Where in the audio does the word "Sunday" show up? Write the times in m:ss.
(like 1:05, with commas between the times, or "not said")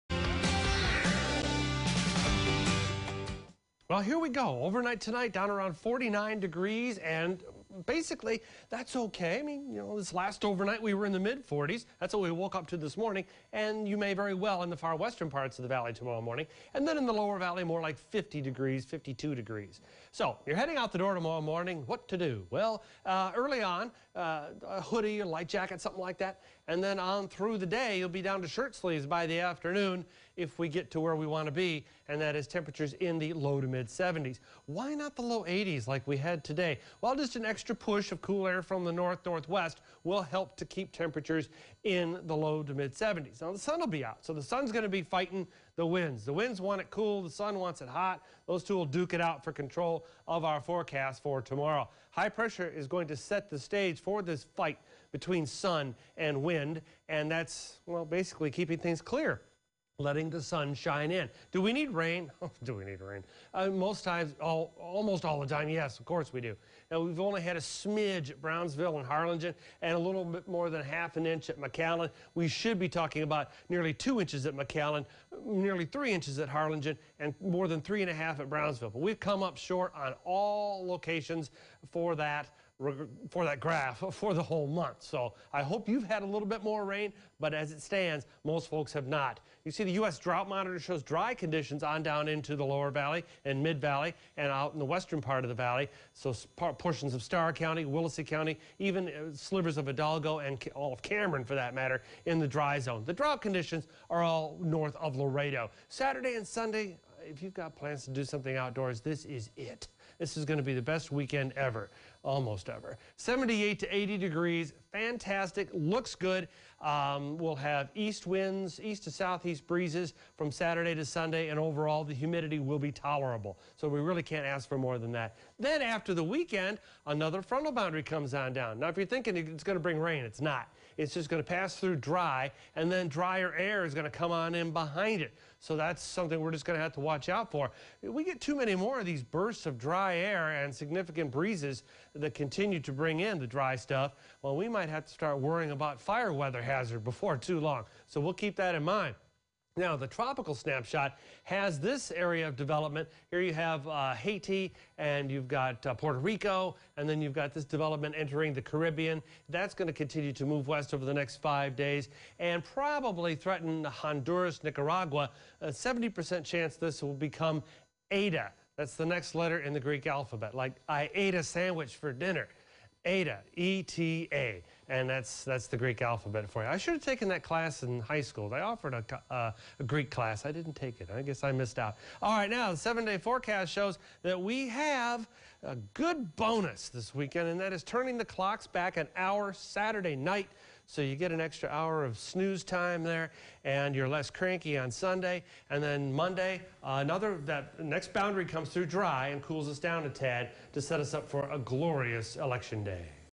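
1:46, 2:01, 3:14.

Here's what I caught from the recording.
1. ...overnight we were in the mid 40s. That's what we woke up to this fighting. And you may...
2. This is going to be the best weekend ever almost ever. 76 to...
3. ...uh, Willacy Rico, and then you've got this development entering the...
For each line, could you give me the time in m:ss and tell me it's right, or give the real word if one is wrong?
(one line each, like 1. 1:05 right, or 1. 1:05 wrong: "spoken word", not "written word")
1. 0:10 wrong: "morning", not "fighting"
2. 1:50 wrong: "78", not "76"
3. 2:35 wrong: "Puerto", not "Willacy".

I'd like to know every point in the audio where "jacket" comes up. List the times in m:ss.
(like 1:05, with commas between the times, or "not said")
0:25.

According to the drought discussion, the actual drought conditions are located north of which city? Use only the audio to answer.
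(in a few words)
Laredo.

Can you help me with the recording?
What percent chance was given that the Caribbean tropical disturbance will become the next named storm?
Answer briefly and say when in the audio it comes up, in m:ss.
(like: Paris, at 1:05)
70%, at 2:45.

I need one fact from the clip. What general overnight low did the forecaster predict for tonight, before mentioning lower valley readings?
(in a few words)
49 degrees.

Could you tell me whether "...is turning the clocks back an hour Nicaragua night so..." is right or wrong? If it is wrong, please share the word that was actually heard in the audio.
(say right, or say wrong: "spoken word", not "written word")
wrong: "Saturday", not "Nicaragua".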